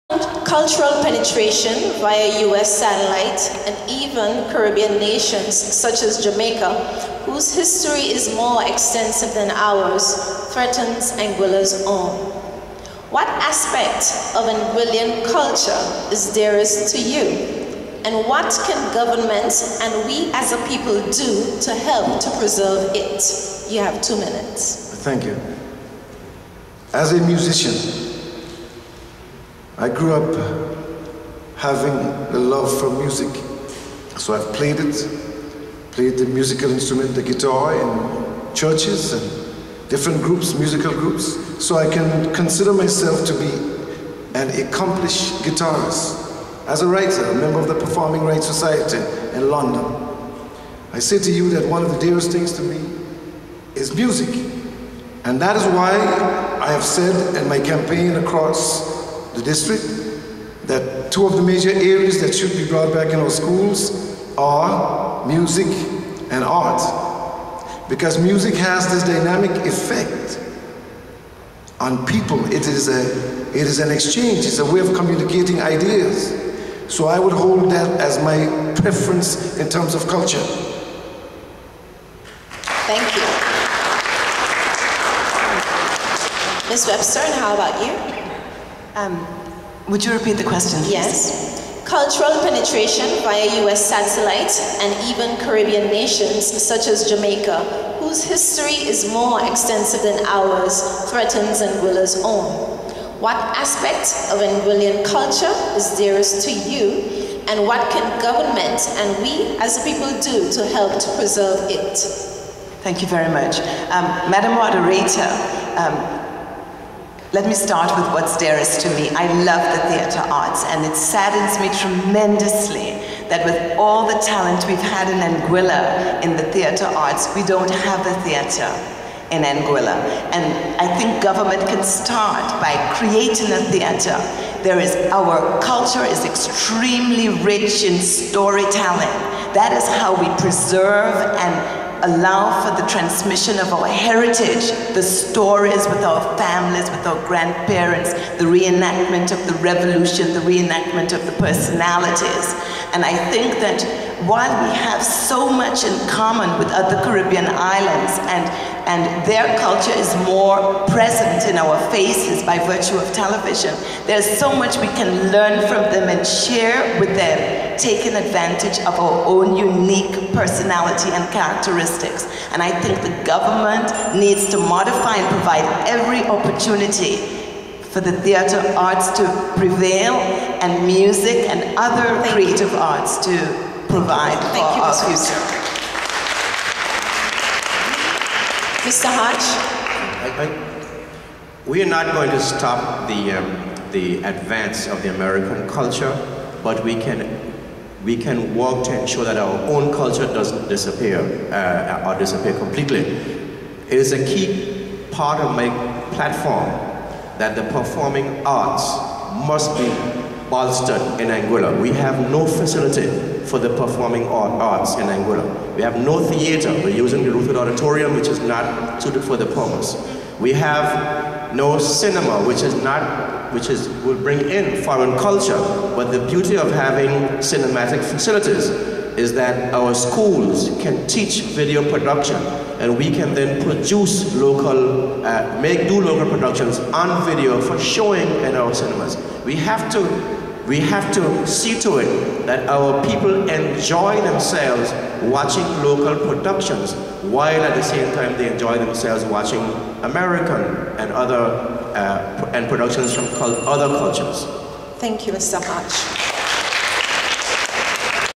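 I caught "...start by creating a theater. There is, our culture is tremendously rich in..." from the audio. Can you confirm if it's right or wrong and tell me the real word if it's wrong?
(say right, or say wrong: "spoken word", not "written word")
wrong: "extremely", not "tremendously".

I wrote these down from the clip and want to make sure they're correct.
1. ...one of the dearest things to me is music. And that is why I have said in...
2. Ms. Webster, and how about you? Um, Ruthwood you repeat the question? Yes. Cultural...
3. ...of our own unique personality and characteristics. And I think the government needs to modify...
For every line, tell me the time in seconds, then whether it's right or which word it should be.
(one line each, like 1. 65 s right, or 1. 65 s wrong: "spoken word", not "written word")
1. 51 s right
2. 86 s wrong: "Would", not "Ruthwood"
3. 168 s right.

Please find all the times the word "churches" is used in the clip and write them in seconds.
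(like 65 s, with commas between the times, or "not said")
38 s.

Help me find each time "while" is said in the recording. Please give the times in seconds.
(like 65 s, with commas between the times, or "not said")
154 s, 247 s.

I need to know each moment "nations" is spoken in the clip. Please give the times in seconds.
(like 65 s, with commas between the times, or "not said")
4 s, 95 s.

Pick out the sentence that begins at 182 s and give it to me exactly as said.
arts to provide Thank for you, our future.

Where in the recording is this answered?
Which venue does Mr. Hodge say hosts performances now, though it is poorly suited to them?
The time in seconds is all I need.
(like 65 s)
217 s.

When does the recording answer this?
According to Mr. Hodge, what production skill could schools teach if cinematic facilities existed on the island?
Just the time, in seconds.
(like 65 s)
231 s.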